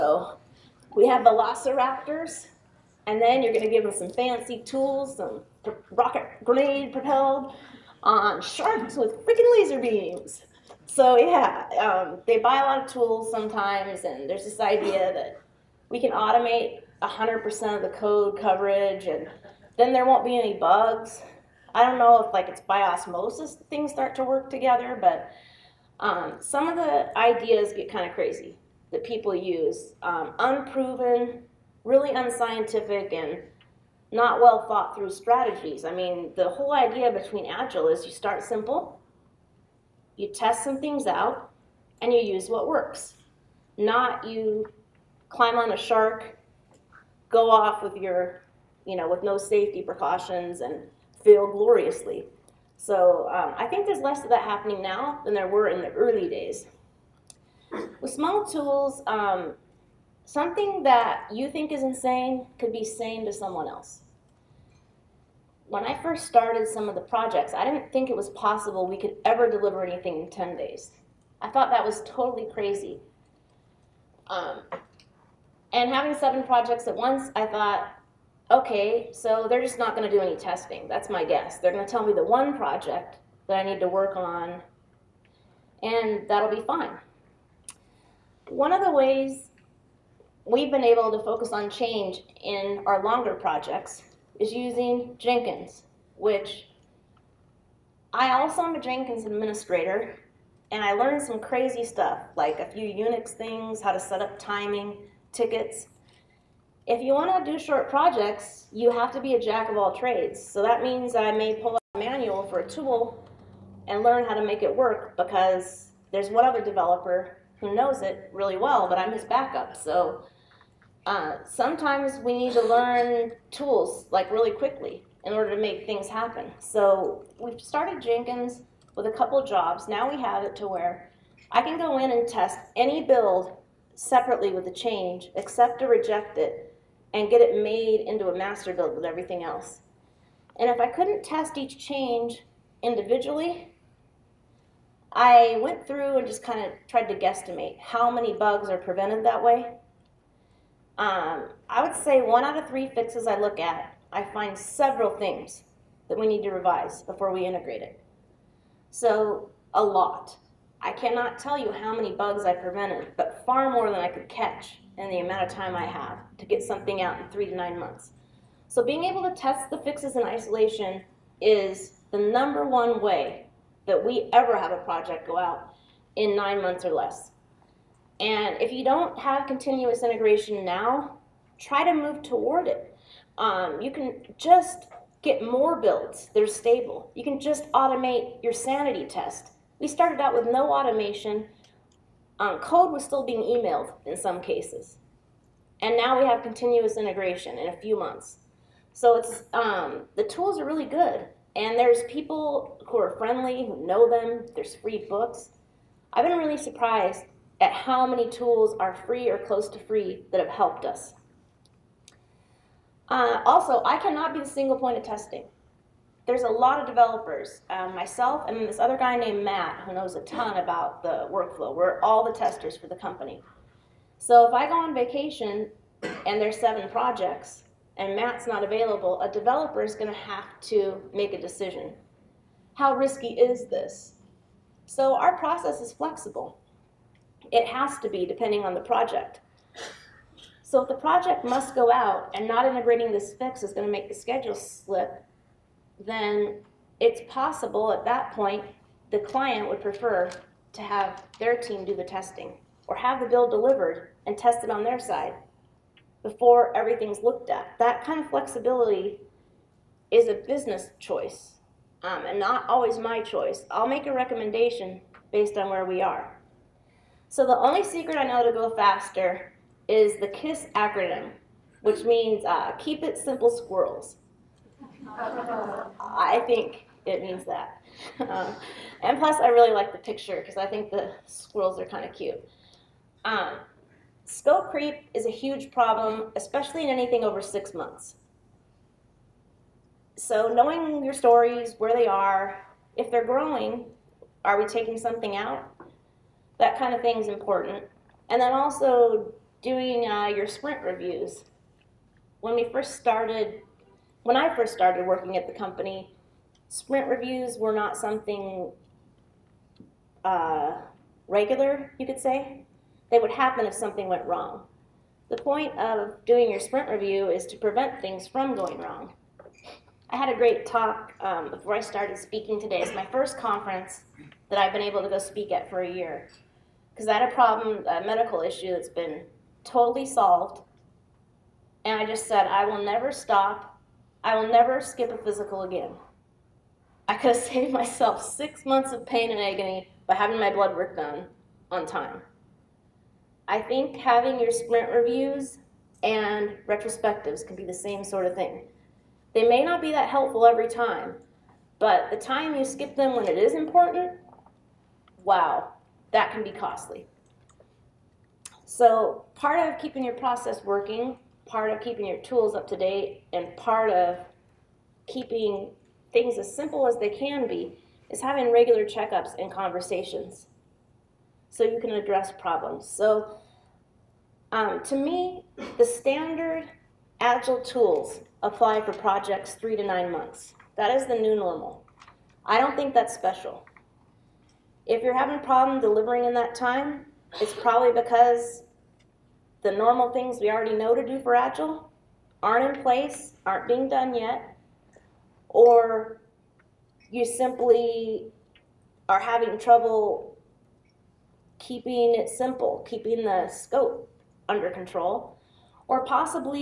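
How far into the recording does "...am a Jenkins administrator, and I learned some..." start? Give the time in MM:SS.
01:38.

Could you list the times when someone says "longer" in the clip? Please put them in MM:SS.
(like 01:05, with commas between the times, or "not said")
01:33.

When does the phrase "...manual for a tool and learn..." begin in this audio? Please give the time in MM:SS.
01:51.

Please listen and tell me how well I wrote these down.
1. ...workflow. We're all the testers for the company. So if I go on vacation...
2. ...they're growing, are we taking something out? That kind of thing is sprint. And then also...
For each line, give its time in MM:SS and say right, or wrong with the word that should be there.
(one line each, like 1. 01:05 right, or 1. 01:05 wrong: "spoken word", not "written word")
1. 03:41 right
2. 04:53 wrong: "important", not "sprint".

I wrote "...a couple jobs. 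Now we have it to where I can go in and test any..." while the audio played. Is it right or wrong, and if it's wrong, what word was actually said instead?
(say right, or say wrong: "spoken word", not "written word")
right.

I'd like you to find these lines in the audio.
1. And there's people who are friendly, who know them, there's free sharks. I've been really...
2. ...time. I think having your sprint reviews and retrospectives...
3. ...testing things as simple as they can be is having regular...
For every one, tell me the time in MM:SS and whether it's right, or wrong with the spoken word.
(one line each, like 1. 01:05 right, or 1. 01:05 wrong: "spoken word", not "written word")
1. 03:21 wrong: "books", not "sharks"
2. 05:41 right
3. 06:05 wrong: "keeping", not "testing".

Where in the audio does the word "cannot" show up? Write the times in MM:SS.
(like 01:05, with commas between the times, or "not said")
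02:40, 03:33.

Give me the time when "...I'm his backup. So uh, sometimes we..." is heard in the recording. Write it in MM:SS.
01:58.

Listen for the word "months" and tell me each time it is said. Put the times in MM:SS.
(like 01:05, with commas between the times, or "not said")
02:47, 02:56, 03:17, 04:47, 05:38, 06:20.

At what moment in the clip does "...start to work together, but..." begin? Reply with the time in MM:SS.
00:23.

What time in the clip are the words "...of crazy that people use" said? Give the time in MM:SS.
00:28.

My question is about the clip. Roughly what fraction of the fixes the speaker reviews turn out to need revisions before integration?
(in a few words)
1 out of 3.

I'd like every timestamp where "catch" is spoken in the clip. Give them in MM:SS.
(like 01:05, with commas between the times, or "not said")
02:44.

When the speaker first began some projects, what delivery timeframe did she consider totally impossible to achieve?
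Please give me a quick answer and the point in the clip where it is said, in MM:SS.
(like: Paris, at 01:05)
10 days, at 01:10.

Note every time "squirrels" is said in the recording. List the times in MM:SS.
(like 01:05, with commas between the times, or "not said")
04:33, 04:41.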